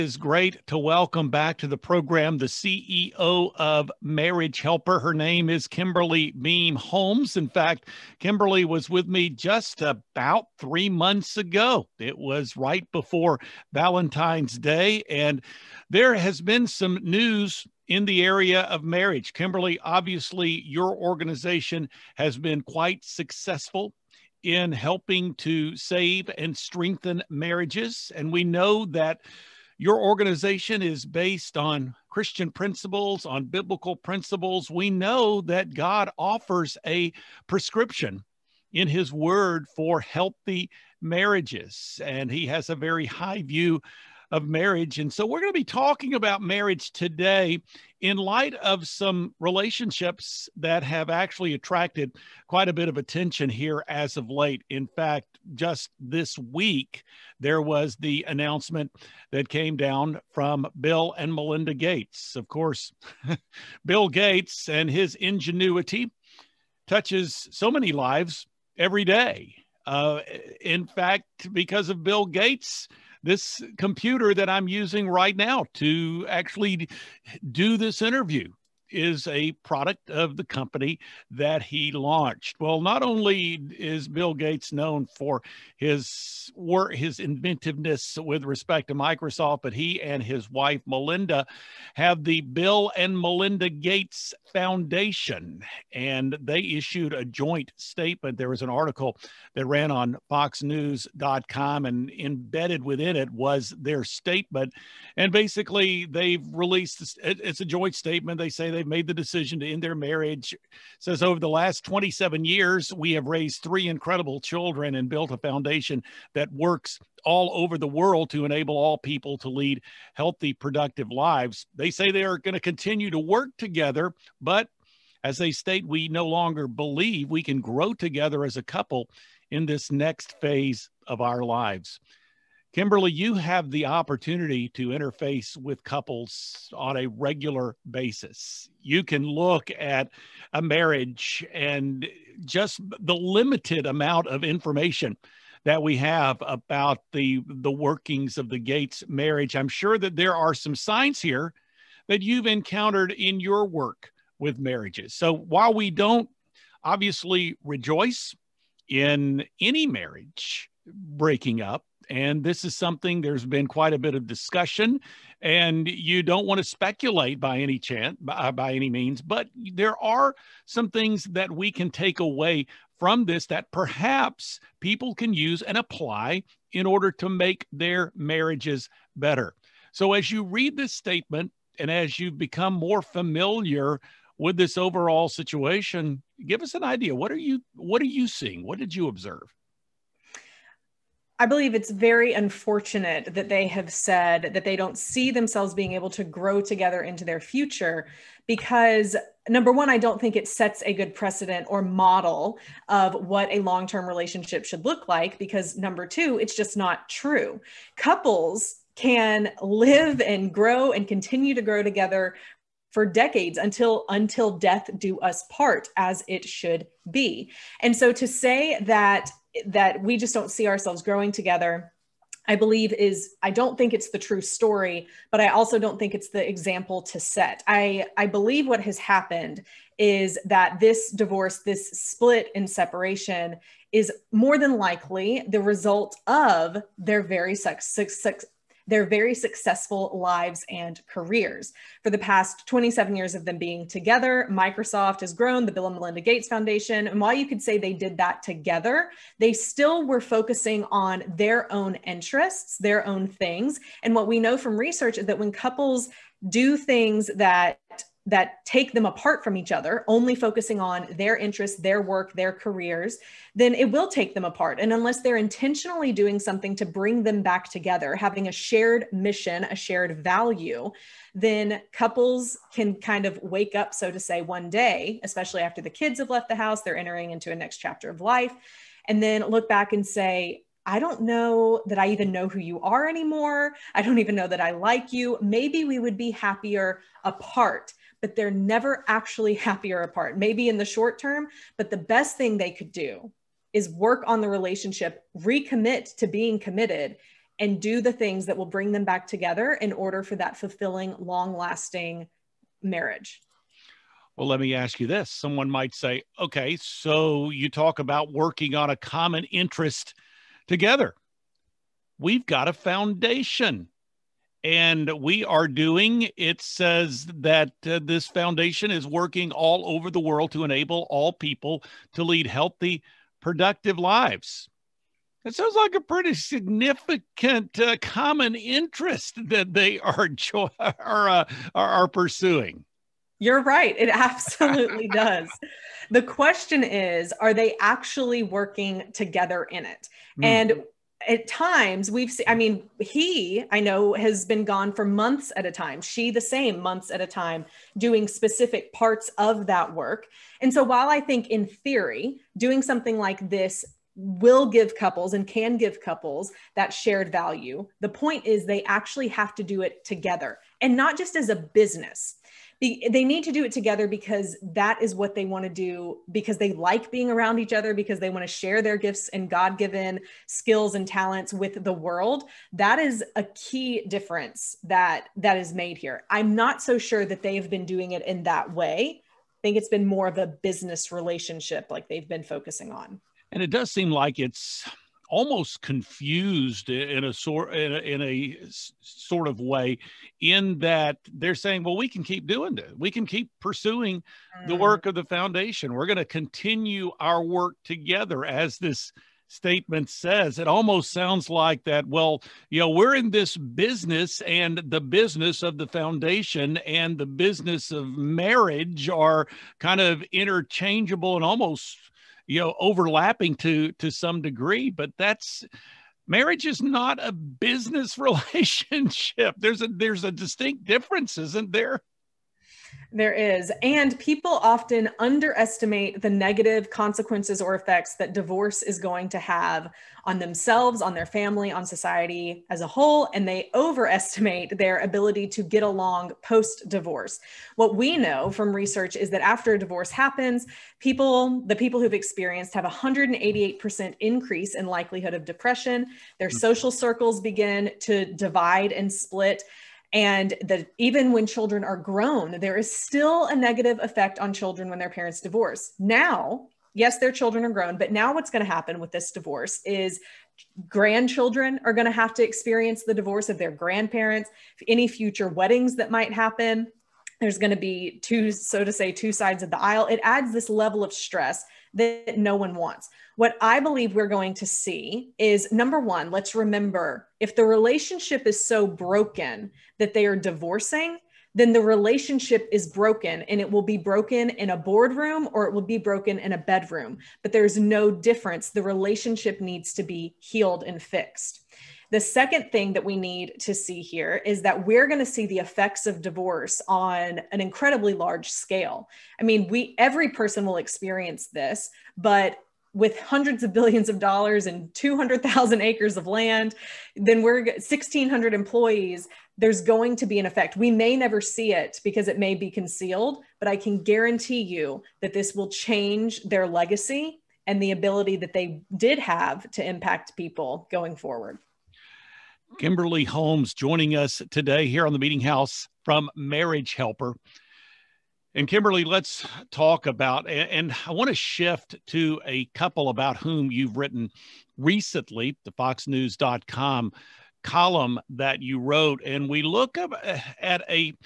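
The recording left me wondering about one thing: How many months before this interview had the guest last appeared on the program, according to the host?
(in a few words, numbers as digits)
3.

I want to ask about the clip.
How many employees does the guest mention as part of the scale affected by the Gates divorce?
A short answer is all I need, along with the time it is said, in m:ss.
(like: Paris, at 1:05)
1,600, at 8:27.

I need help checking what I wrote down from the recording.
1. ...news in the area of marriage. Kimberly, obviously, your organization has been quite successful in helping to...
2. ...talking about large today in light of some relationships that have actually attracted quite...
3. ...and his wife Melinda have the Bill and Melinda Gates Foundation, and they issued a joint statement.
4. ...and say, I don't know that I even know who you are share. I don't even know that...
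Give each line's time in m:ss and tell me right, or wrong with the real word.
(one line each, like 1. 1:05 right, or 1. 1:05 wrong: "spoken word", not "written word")
1. 0:17 right
2. 0:45 wrong: "marriage", not "large"
3. 1:30 right
4. 4:39 wrong: "anymore", not "share".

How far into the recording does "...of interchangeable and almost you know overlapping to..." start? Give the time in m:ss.
6:50.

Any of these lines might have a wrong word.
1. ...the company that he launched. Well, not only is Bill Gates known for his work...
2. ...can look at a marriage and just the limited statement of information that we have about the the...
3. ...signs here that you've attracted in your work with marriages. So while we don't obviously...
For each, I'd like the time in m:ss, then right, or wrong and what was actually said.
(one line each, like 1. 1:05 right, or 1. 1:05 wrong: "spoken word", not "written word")
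1. 1:20 right
2. 2:19 wrong: "amount", not "statement"
3. 2:30 wrong: "encountered", not "attracted".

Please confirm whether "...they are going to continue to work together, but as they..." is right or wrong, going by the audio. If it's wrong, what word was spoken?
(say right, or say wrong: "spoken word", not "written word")
right.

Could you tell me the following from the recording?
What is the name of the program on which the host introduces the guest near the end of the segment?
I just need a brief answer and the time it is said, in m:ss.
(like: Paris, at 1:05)
the Meeting House, at 8:45.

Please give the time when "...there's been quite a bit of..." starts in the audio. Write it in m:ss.
2:43.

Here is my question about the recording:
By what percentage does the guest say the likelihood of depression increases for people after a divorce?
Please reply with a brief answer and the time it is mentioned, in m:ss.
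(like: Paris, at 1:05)
188%, at 7:22.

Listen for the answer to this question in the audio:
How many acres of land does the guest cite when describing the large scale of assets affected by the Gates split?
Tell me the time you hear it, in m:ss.
8:24.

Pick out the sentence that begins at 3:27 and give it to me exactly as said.
Couples can live and grow and continue to grow together for decades until until death do us part as it should be.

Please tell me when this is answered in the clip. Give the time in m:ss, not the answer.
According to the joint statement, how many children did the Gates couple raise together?
1:53.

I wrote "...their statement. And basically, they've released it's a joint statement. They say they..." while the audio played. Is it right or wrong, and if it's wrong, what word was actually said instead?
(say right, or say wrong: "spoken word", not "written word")
right.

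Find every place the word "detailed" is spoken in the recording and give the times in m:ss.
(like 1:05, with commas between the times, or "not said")
not said.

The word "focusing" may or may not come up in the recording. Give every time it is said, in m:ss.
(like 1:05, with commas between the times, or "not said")
4:10, 4:20, 6:22.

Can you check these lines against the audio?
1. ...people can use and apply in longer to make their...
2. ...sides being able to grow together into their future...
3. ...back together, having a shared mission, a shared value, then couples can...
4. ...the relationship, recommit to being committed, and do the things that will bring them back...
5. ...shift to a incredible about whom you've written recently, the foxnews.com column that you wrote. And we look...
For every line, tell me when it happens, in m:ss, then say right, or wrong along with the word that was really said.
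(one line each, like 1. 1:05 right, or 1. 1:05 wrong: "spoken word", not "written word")
1. 2:54 wrong: "order", not "longer"
2. 3:15 wrong: "themselves", not "sides"
3. 4:27 right
4. 4:54 right
5. 8:51 wrong: "couple", not "incredible".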